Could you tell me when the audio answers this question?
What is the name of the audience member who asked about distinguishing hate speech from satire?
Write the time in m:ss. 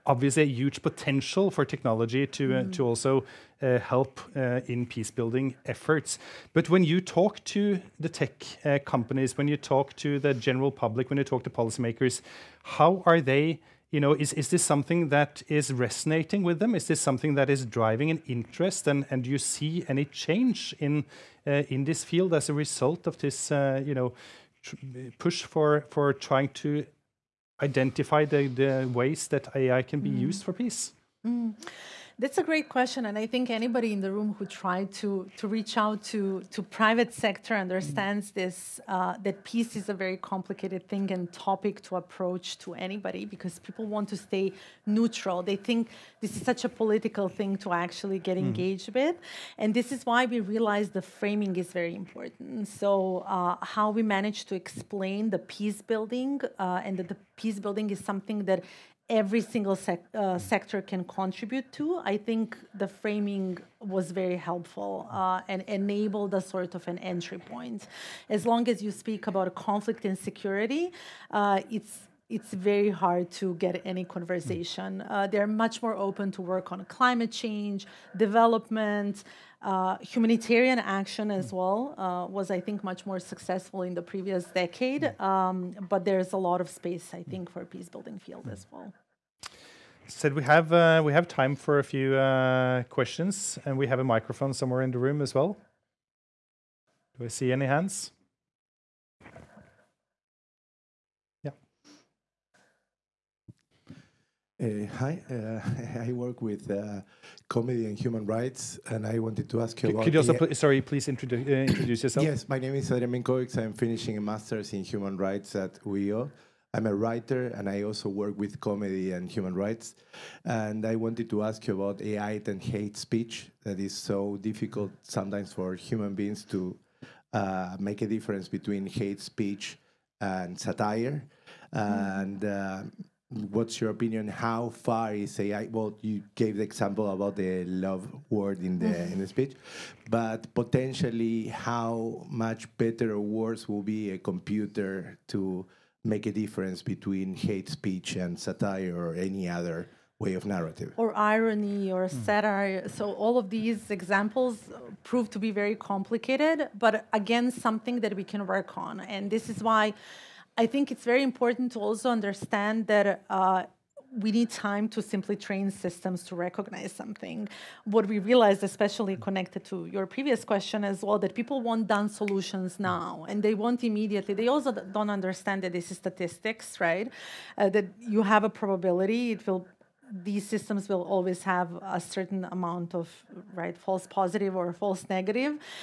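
1:52.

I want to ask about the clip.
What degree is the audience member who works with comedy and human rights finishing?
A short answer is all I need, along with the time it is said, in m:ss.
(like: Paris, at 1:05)
Master's in human rights, at 1:54.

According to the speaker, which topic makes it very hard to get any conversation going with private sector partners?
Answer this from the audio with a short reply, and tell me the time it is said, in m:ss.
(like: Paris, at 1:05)
Conflict and security, at 1:09.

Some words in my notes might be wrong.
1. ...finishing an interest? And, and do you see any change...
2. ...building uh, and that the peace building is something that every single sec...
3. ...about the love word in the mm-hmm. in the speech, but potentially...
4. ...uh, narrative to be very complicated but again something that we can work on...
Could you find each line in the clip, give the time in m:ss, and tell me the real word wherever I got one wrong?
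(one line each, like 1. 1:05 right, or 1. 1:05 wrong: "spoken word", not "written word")
1. 0:17 wrong: "driving", not "finishing"
2. 0:55 right
3. 2:17 right
4. 2:34 wrong: "prove", not "narrative".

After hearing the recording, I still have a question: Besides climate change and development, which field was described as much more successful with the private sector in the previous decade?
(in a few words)
Humanitarian action.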